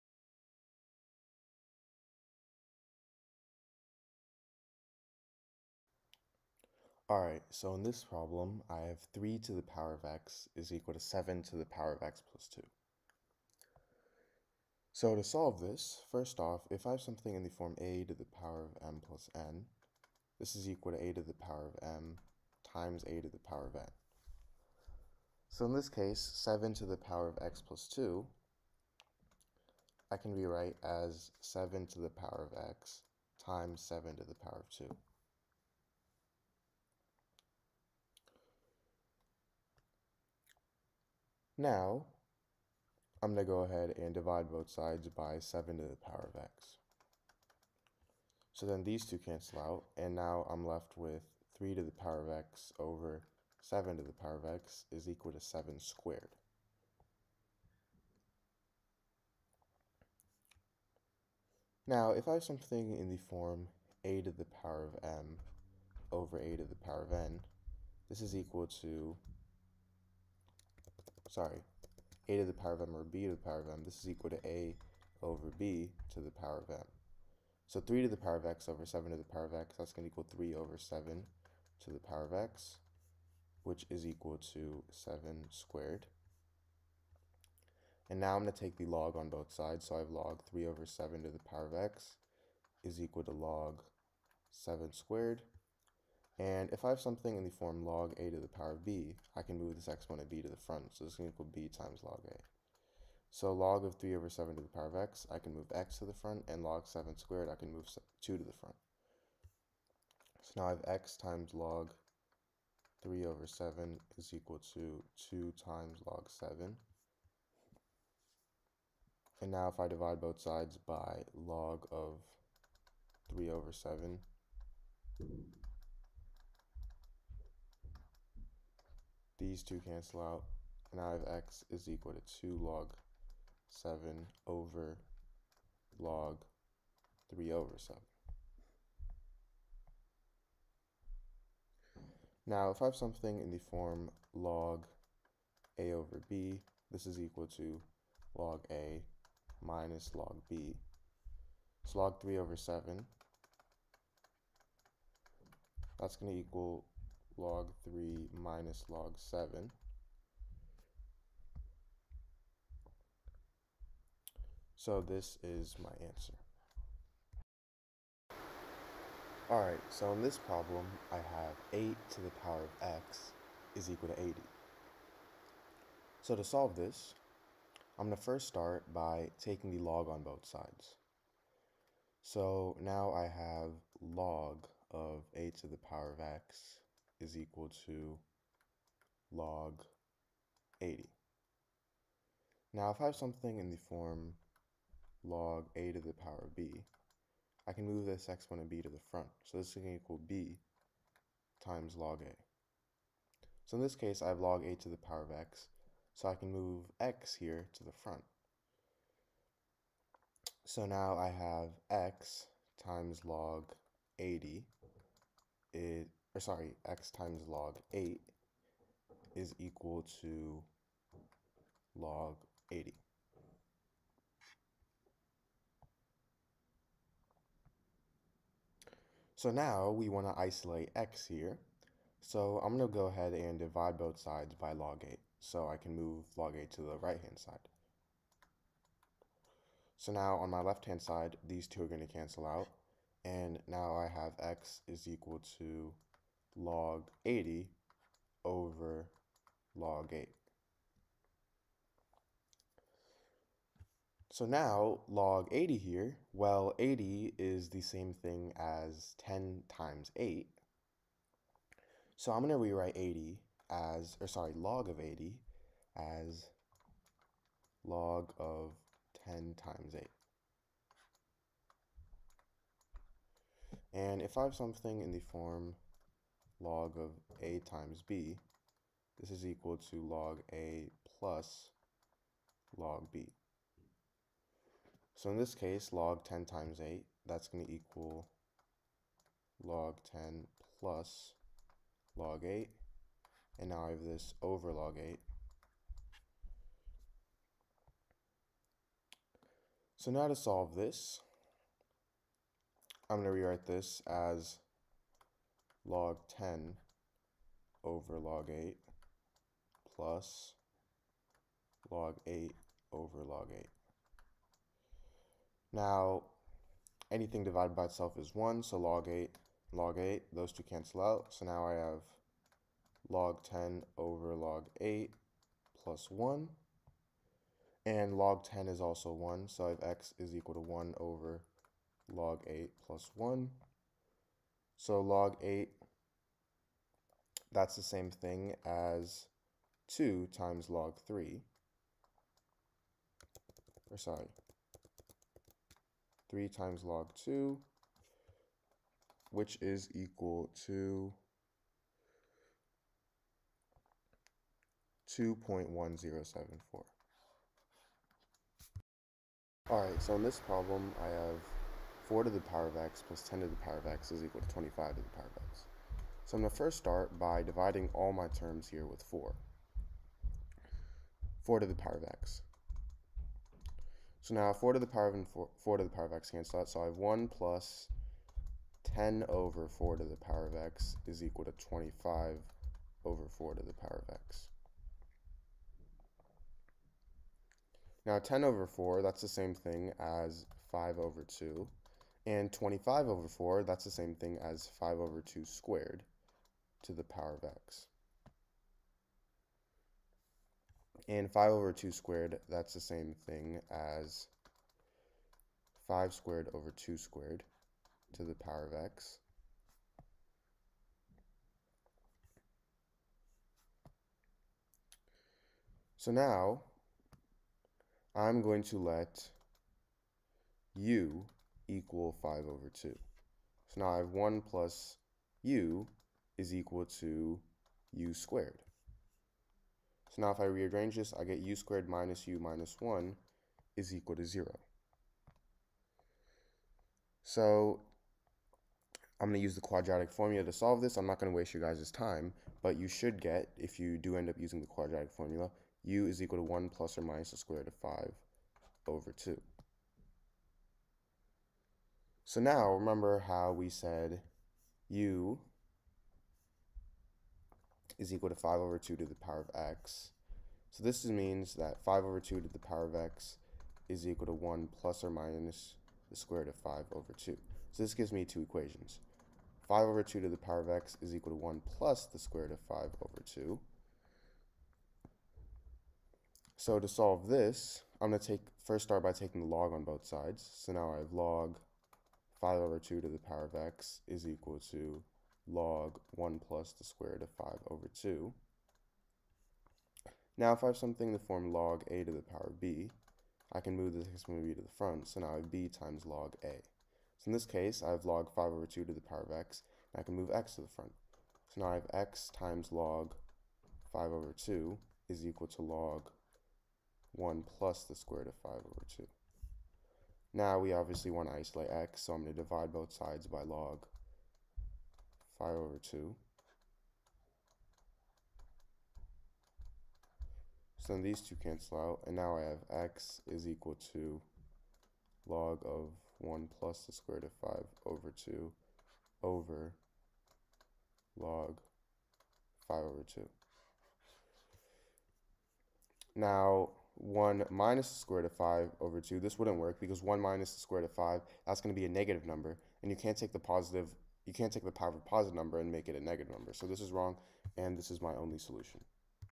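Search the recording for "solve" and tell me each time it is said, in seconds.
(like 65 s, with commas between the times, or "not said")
15 s, 176 s, 300 s, 440 s, 476 s.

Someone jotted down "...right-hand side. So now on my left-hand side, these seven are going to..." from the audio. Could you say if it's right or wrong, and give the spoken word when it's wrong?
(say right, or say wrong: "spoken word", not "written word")
wrong: "two", not "seven".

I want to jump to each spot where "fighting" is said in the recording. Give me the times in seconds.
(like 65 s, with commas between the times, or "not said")
not said.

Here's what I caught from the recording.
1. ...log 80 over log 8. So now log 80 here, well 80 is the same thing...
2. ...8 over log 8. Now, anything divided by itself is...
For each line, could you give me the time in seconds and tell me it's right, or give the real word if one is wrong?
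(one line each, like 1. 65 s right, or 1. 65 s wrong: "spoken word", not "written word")
1. 246 s right
2. 312 s right.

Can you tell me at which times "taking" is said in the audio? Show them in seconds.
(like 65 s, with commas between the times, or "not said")
179 s, 479 s.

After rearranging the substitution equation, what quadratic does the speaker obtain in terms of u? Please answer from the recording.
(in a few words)
u^2 - u - 1 = 0.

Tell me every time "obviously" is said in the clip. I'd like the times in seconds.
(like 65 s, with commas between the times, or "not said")
510 s.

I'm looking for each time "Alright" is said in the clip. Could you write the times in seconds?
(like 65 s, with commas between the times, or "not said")
7 s, 169 s, 359 s.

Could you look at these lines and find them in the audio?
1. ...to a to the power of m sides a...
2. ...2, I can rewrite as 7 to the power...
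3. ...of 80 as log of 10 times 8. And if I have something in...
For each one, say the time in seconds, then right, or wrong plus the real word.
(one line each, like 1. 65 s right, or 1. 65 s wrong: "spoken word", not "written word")
1. 20 s wrong: "times", not "sides"
2. 27 s right
3. 264 s right.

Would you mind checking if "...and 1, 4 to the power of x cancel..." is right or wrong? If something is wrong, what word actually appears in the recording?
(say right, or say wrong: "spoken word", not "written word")
wrong: "4", not "1".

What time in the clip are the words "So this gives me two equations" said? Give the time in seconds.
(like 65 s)
467 s.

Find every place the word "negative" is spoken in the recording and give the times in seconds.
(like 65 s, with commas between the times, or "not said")
541 s, 546 s.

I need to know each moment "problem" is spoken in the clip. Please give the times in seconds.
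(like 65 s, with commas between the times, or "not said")
8 s, 170 s, 360 s.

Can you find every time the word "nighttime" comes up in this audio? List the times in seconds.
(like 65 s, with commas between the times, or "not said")
not said.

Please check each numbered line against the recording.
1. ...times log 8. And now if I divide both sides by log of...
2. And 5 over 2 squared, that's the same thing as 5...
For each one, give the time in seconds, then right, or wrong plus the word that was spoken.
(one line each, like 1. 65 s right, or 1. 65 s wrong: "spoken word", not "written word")
1. 115 s wrong: "7", not "8"
2. 401 s right.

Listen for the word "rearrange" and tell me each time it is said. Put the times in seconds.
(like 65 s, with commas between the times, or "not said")
430 s.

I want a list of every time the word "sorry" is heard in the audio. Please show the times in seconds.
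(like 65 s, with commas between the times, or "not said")
71 s, 216 s, 264 s, 343 s.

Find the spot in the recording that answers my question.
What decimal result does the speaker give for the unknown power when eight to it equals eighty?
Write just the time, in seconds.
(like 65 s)
355 s.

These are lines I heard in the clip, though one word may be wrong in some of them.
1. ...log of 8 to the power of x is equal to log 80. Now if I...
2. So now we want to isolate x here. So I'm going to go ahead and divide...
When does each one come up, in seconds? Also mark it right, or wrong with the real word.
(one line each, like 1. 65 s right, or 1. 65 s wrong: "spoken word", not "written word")
1. 184 s right
2. 229 s right.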